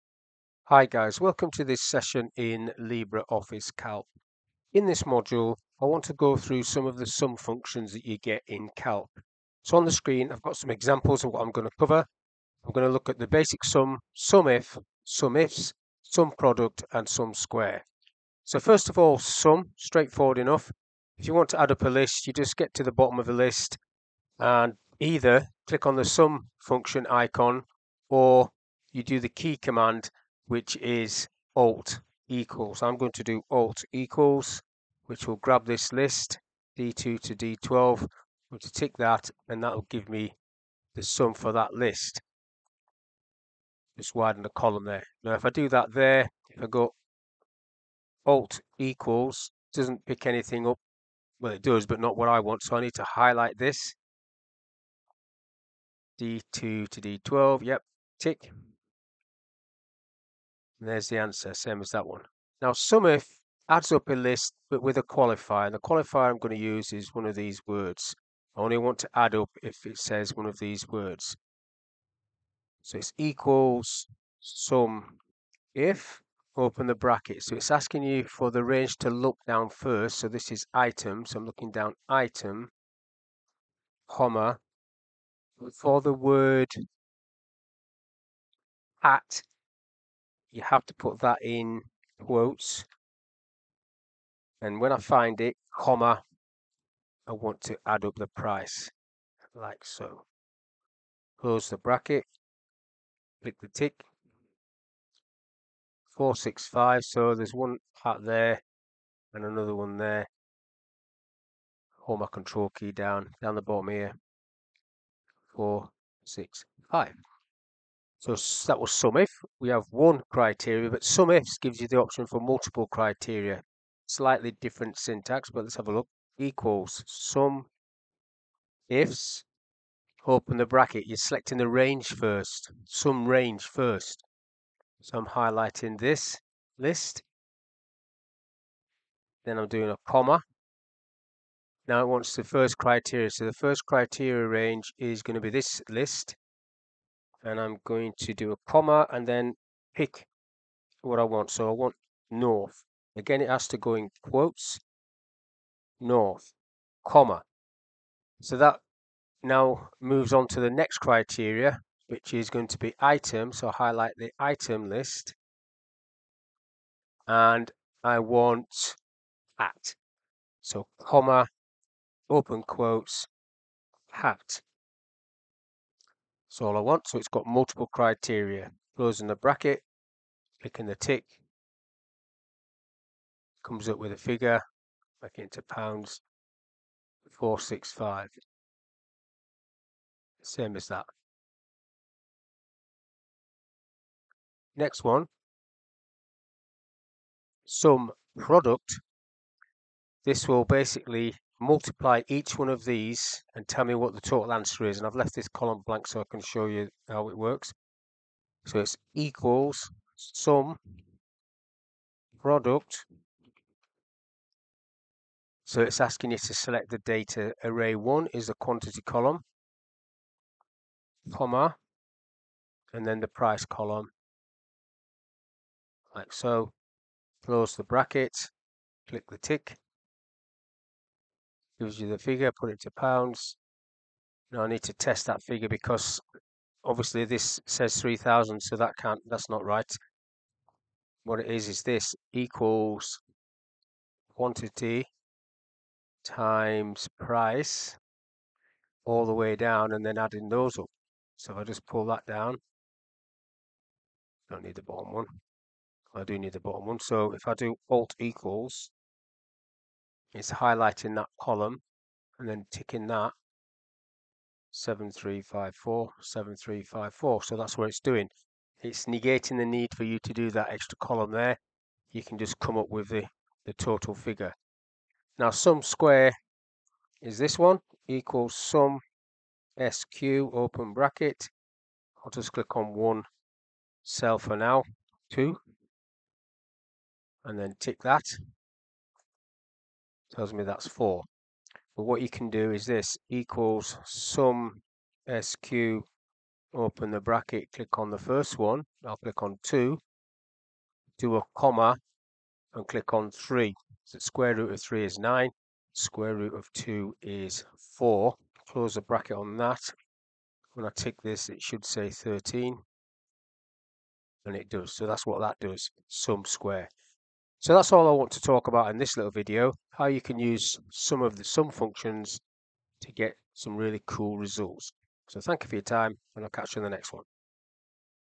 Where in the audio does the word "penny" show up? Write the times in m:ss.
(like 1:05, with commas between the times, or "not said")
not said.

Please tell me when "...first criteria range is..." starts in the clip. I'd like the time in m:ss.
2:23.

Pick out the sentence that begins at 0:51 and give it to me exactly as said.
Well, it does, but not what I want.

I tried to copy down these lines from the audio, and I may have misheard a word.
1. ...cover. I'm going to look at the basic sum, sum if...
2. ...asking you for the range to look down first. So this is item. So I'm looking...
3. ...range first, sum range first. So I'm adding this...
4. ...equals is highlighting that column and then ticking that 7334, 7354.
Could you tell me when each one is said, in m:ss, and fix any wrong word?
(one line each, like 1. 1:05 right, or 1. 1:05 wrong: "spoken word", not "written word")
1. 0:11 right
2. 1:17 right
3. 2:11 wrong: "highlighting", not "adding"
4. 4:18 wrong: "7354", not "7334".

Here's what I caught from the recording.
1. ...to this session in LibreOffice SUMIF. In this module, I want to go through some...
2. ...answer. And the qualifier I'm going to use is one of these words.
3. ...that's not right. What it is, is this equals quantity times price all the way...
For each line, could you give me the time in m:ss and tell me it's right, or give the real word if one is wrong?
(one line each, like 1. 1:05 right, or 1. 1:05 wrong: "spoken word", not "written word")
1. 0:01 wrong: "Calc", not "SUMIF"
2. 1:05 wrong: "qualifier", not "answer"
3. 3:59 right.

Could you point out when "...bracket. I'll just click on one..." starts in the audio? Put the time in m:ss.
4:40.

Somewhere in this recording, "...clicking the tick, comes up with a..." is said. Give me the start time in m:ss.
3:00.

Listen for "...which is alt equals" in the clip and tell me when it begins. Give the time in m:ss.
0:30.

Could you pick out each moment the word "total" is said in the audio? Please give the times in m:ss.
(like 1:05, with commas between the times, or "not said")
3:24, 4:33.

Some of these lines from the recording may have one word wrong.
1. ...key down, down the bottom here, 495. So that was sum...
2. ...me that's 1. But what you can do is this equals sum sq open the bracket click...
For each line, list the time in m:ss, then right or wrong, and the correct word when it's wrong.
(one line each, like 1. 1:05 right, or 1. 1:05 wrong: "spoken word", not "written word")
1. 1:52 wrong: "465", not "495"
2. 4:50 wrong: "4", not "1".